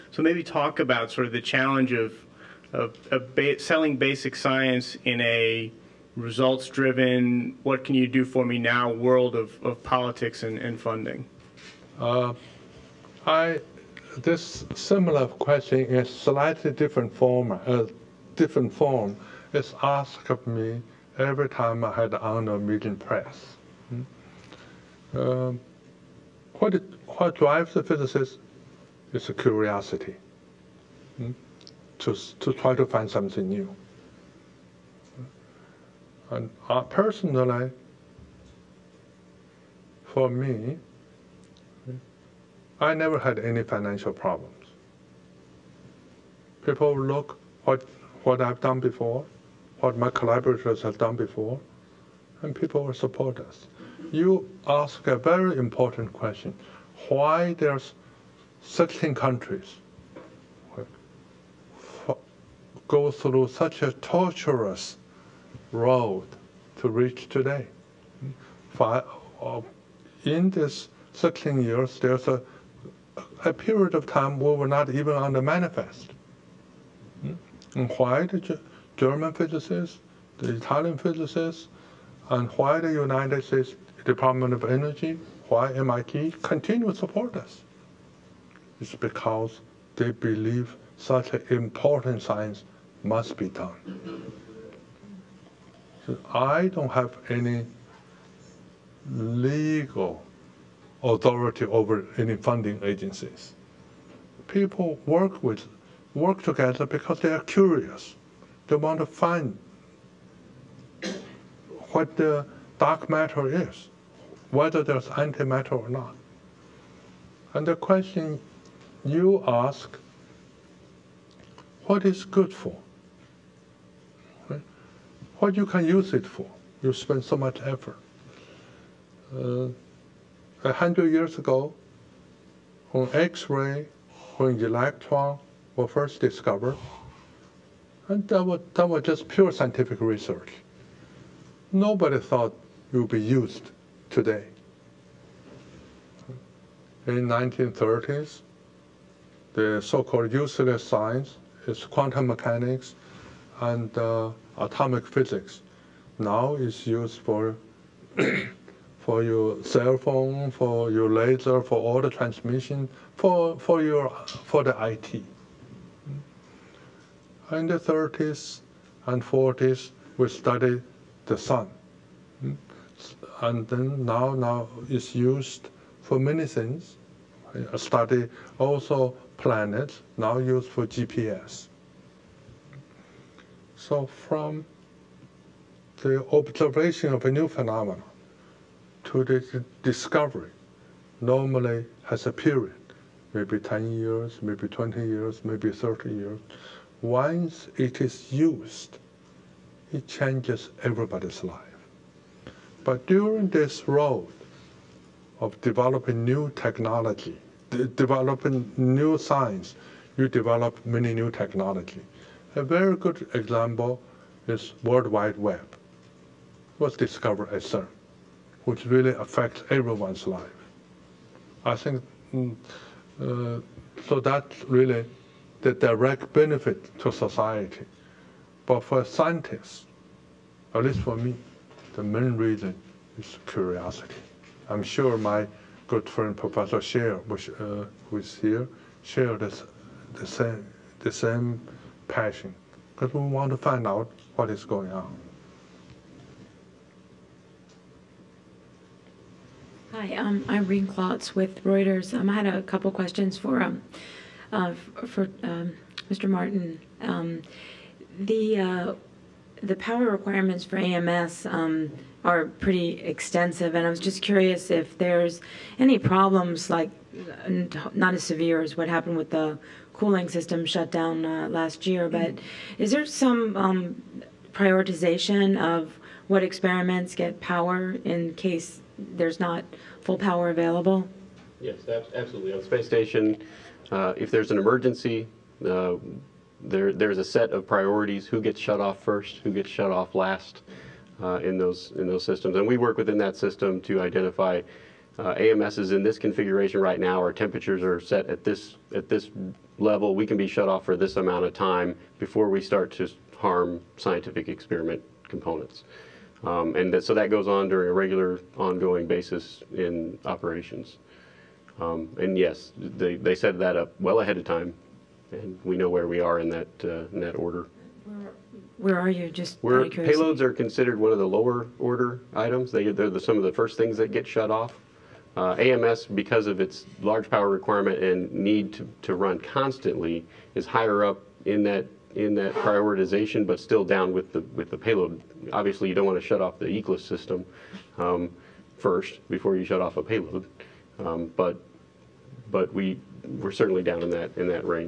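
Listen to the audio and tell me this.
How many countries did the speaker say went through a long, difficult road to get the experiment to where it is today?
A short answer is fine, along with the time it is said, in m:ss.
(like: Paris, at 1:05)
16, at 0:58.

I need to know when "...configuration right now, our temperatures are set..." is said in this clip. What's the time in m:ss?
4:56.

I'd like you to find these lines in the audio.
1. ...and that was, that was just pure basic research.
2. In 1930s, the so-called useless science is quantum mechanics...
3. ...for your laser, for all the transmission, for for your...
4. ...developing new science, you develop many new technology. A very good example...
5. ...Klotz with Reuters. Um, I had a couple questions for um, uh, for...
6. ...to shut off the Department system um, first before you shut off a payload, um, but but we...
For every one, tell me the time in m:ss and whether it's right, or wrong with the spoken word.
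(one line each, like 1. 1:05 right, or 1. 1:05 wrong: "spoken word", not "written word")
1. 2:18 wrong: "scientific", not "basic"
2. 2:27 right
3. 2:40 right
4. 3:27 right
5. 4:10 right
6. 5:36 wrong: "ECLSS", not "Department".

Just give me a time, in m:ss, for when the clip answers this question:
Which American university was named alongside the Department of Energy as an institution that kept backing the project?
1:25.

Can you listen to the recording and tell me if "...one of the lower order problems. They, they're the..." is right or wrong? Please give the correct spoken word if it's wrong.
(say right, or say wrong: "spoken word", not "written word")
wrong: "items", not "problems".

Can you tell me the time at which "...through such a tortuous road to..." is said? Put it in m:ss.
1:03.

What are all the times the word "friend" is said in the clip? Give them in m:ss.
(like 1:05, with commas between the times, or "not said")
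3:56.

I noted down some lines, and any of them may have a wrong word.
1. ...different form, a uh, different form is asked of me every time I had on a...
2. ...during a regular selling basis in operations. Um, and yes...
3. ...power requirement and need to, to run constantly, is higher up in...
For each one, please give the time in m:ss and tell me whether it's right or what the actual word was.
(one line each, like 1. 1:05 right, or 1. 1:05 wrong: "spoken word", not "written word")
1. 0:16 right
2. 5:07 wrong: "ongoing", not "selling"
3. 5:27 right.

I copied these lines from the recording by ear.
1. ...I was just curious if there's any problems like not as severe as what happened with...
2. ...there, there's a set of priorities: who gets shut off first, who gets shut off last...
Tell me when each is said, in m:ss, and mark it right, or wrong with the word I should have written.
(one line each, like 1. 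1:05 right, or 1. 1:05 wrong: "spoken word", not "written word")
1. 4:23 right
2. 4:46 right.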